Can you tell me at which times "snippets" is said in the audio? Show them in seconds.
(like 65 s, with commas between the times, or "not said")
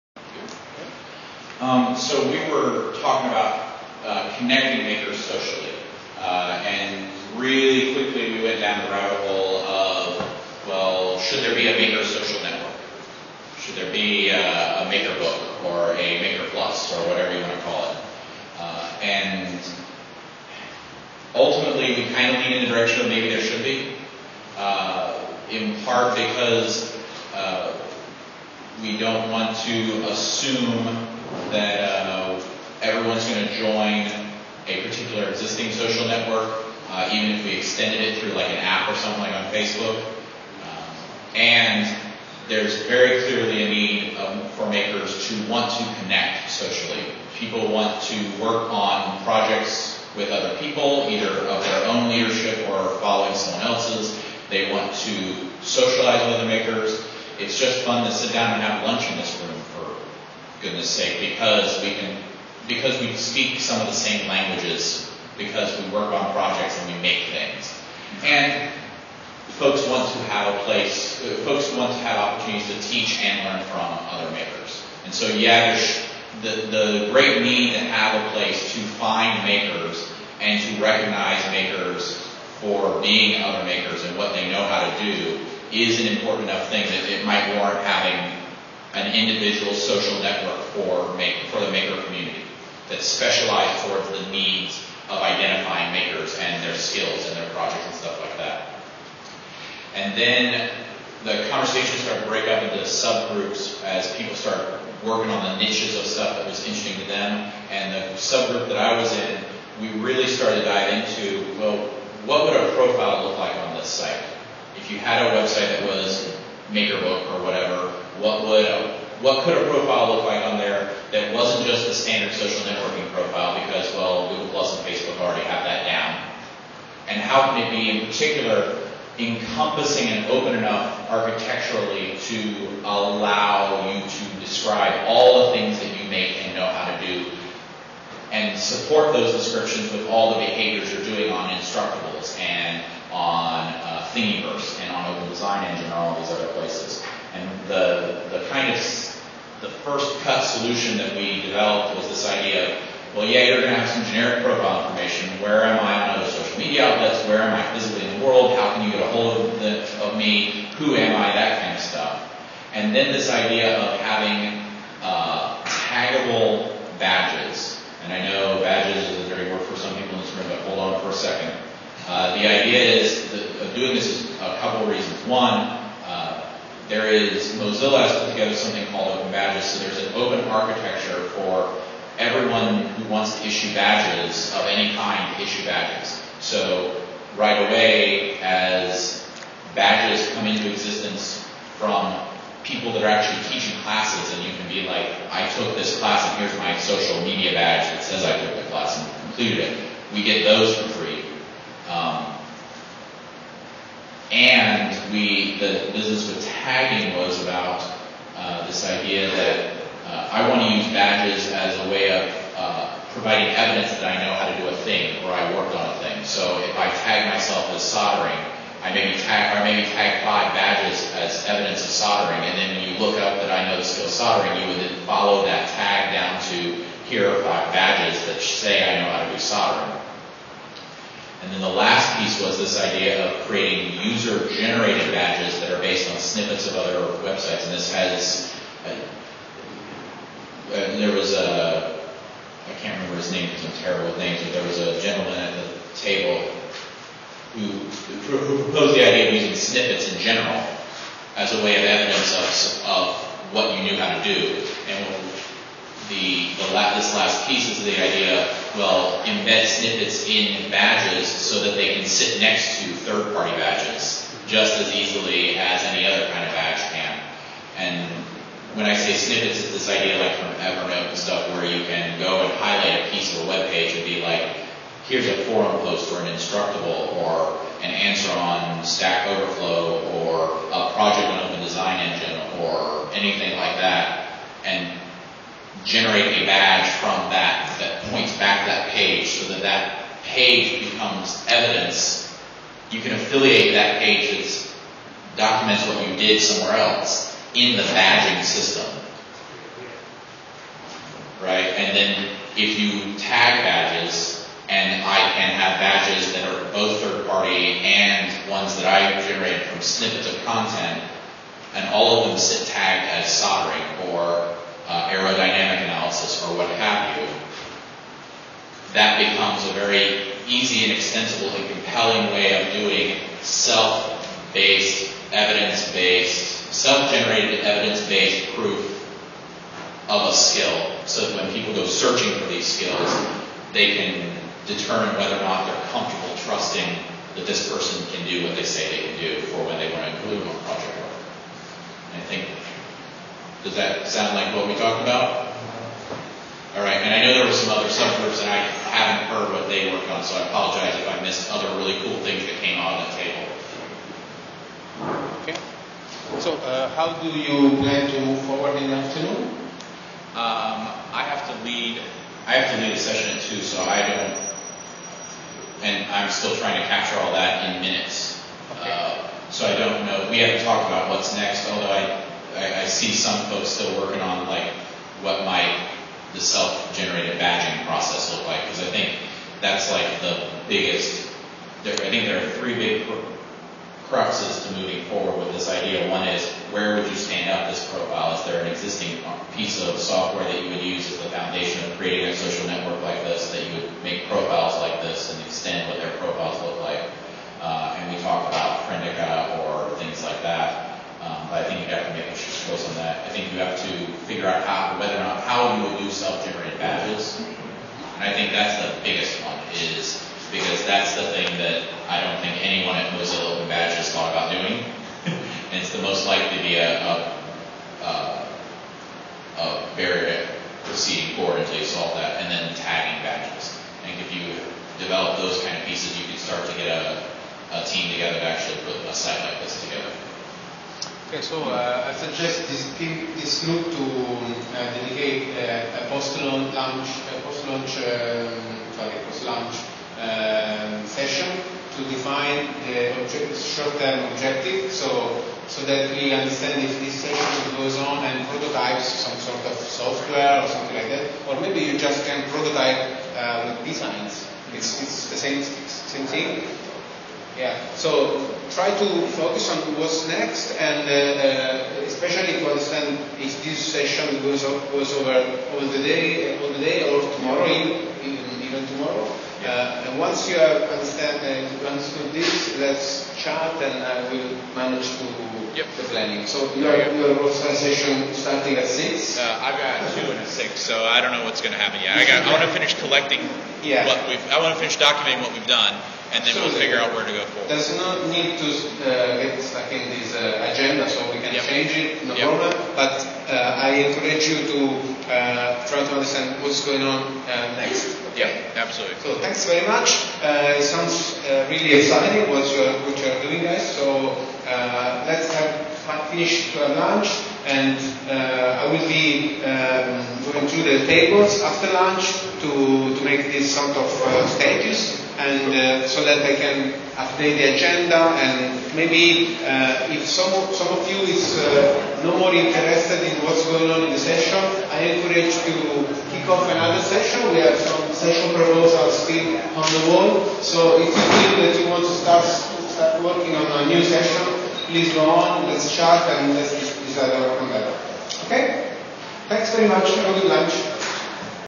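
236 s, 249 s, 259 s, 269 s, 309 s.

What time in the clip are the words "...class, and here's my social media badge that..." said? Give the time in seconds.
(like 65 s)
195 s.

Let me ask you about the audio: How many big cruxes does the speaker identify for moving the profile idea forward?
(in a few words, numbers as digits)
3.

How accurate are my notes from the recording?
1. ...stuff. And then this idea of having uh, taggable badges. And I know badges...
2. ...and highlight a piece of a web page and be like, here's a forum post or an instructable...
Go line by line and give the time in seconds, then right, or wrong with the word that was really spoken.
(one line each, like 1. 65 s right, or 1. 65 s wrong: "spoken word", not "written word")
1. 161 s right
2. 272 s right.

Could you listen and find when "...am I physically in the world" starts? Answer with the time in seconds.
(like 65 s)
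157 s.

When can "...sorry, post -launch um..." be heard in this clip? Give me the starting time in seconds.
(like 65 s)
438 s.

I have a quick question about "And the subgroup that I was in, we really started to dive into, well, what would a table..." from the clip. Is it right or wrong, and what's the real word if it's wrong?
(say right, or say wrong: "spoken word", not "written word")
wrong: "profile", not "table".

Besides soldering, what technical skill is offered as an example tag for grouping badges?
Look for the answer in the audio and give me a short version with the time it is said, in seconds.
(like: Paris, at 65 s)
Aerodynamic analysis, at 315 s.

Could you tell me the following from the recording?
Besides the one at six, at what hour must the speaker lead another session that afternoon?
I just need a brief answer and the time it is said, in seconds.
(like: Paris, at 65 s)
2, at 363 s.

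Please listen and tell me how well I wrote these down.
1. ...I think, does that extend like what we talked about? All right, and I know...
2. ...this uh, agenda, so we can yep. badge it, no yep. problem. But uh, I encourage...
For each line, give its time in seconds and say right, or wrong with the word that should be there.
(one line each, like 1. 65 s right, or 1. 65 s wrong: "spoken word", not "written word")
1. 342 s wrong: "sound", not "extend"
2. 490 s wrong: "change", not "badge".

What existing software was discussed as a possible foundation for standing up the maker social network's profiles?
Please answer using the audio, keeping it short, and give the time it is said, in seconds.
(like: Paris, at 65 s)
Friendica, at 398 s.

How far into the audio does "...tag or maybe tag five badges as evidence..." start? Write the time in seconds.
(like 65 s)
219 s.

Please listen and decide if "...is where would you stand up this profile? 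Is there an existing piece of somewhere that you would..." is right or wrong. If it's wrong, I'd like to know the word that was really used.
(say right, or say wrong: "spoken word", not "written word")
wrong: "software", not "somewhere".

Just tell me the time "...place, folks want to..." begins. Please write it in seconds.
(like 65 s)
70 s.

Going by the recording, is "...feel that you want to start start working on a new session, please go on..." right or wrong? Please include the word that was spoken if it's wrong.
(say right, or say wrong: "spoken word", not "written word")
right.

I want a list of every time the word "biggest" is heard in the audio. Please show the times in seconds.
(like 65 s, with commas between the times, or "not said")
380 s, 409 s.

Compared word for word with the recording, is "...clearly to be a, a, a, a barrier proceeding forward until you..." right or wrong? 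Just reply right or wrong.
wrong.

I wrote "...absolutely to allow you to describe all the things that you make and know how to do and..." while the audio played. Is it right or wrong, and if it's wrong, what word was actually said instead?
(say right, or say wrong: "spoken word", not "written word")
wrong: "architecturally", not "absolutely".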